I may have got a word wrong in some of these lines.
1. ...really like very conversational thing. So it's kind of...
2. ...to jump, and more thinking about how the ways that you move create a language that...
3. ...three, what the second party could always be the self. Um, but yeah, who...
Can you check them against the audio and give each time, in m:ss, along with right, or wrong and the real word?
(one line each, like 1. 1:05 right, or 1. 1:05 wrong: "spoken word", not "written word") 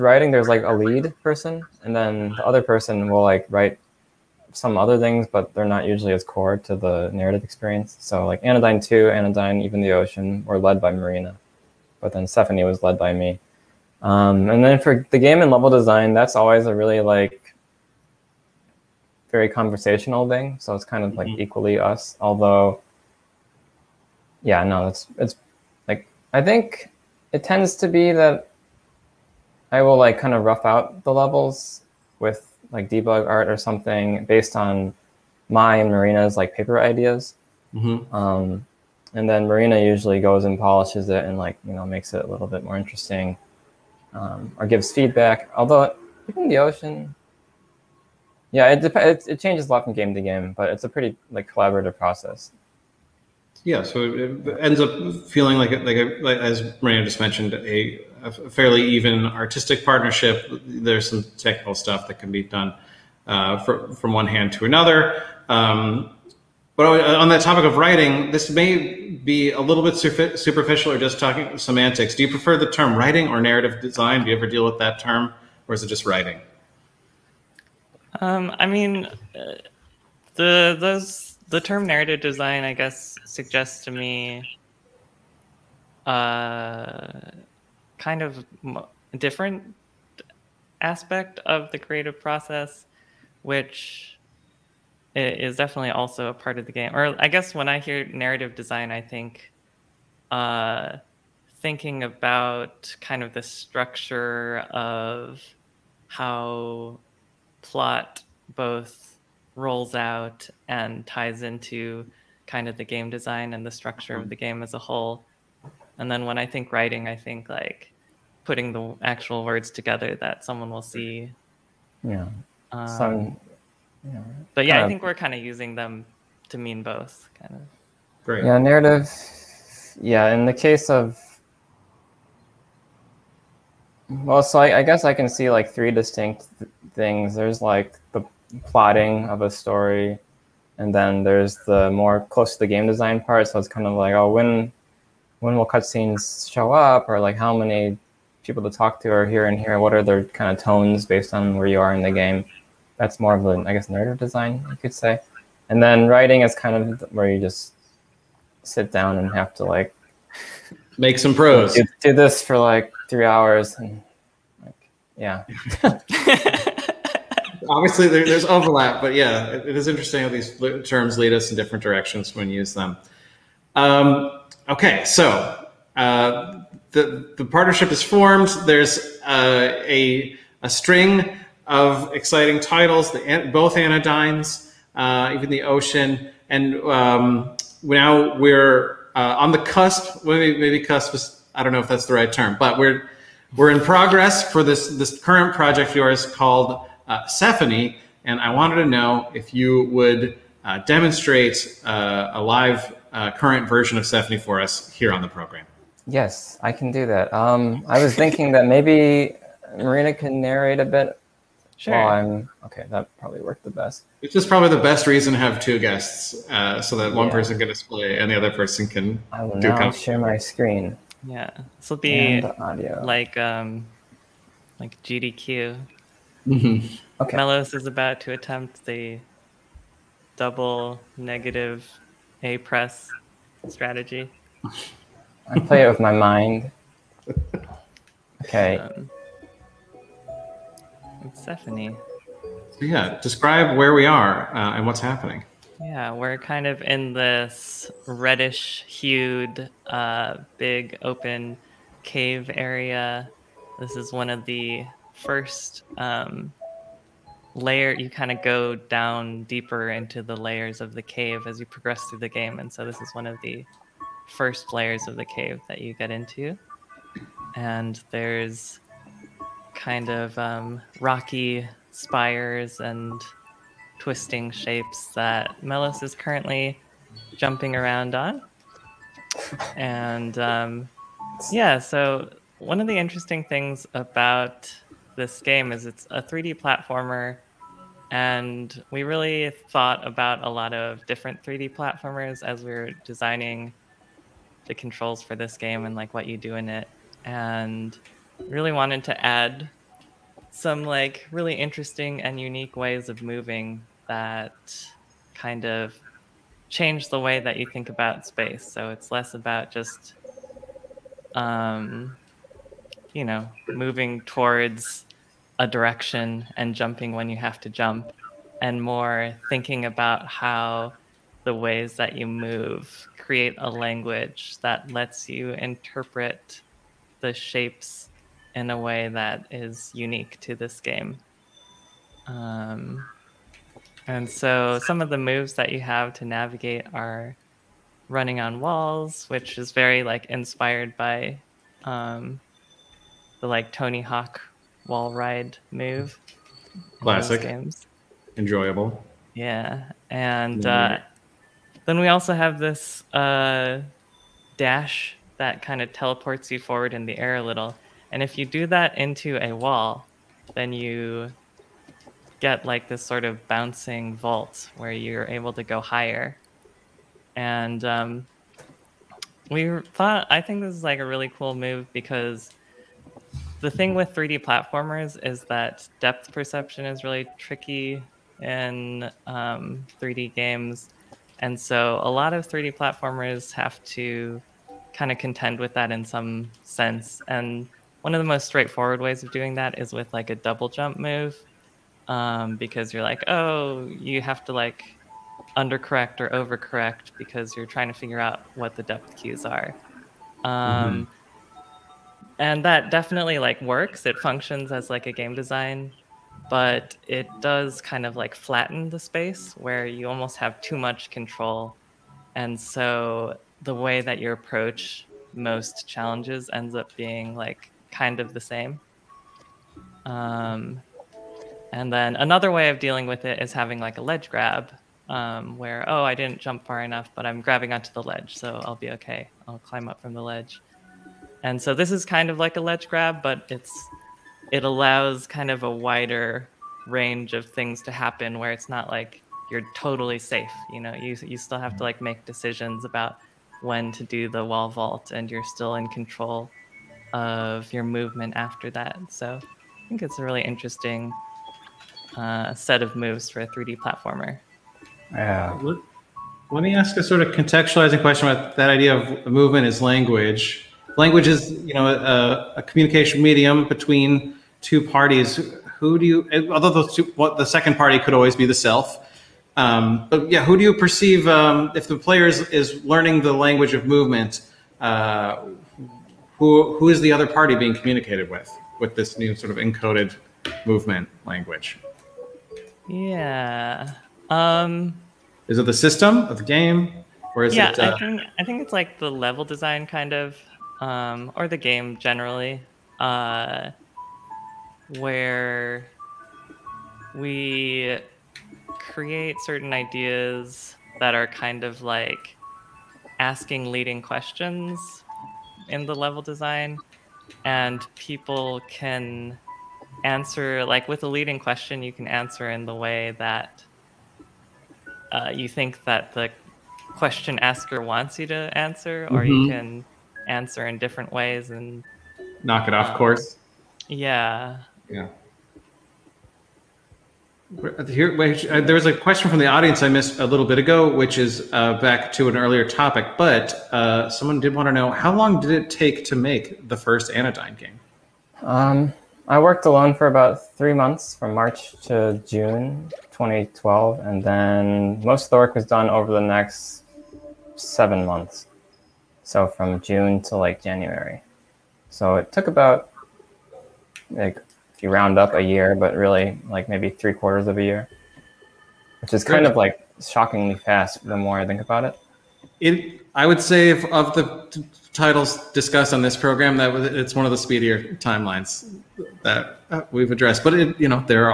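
1. 0:16 right
2. 5:17 right
3. 7:46 wrong: "two", not "three".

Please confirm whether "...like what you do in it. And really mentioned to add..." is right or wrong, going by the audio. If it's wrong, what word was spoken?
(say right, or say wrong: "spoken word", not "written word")
wrong: "wanted", not "mentioned".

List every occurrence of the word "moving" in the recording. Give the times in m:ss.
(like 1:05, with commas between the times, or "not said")
5:03, 5:13.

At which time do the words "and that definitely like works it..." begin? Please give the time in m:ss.
6:42.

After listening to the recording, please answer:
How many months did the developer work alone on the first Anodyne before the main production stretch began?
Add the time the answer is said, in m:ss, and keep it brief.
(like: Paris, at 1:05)
3, at 9:00.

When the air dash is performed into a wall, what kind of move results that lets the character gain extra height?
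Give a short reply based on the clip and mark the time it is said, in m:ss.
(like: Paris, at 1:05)
bouncing vault, at 6:03.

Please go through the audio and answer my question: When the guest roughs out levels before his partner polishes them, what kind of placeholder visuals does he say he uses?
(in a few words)
debug art.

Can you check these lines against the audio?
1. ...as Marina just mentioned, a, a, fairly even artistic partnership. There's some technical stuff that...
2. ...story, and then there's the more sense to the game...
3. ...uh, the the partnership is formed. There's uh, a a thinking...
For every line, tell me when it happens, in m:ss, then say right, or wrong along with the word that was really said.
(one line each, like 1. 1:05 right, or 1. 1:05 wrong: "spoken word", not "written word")
1. 0:56 right
2. 2:19 wrong: "close", not "sense"
3. 2:55 wrong: "string", not "thinking".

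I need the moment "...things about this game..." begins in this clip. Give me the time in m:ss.
4:43.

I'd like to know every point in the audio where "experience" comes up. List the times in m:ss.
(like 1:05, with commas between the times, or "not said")
0:07.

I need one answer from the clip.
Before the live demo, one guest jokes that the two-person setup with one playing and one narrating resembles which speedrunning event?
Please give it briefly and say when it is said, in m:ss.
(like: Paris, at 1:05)
GDQ, at 3:45.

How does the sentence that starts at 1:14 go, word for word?
Do you ever deal with that term, or is it just writing?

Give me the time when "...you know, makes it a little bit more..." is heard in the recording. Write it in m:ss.
0:41.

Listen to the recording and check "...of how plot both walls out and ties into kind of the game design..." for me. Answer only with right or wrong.
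wrong.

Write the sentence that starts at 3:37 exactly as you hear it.
person can display and the other person can.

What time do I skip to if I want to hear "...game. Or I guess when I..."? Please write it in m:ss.
1:36.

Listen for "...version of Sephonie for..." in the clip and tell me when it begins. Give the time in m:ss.
3:23.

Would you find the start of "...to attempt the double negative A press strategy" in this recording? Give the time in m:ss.
3:48.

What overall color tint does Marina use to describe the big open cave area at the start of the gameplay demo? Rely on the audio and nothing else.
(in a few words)
reddish.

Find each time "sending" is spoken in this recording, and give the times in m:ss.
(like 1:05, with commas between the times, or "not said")
not said.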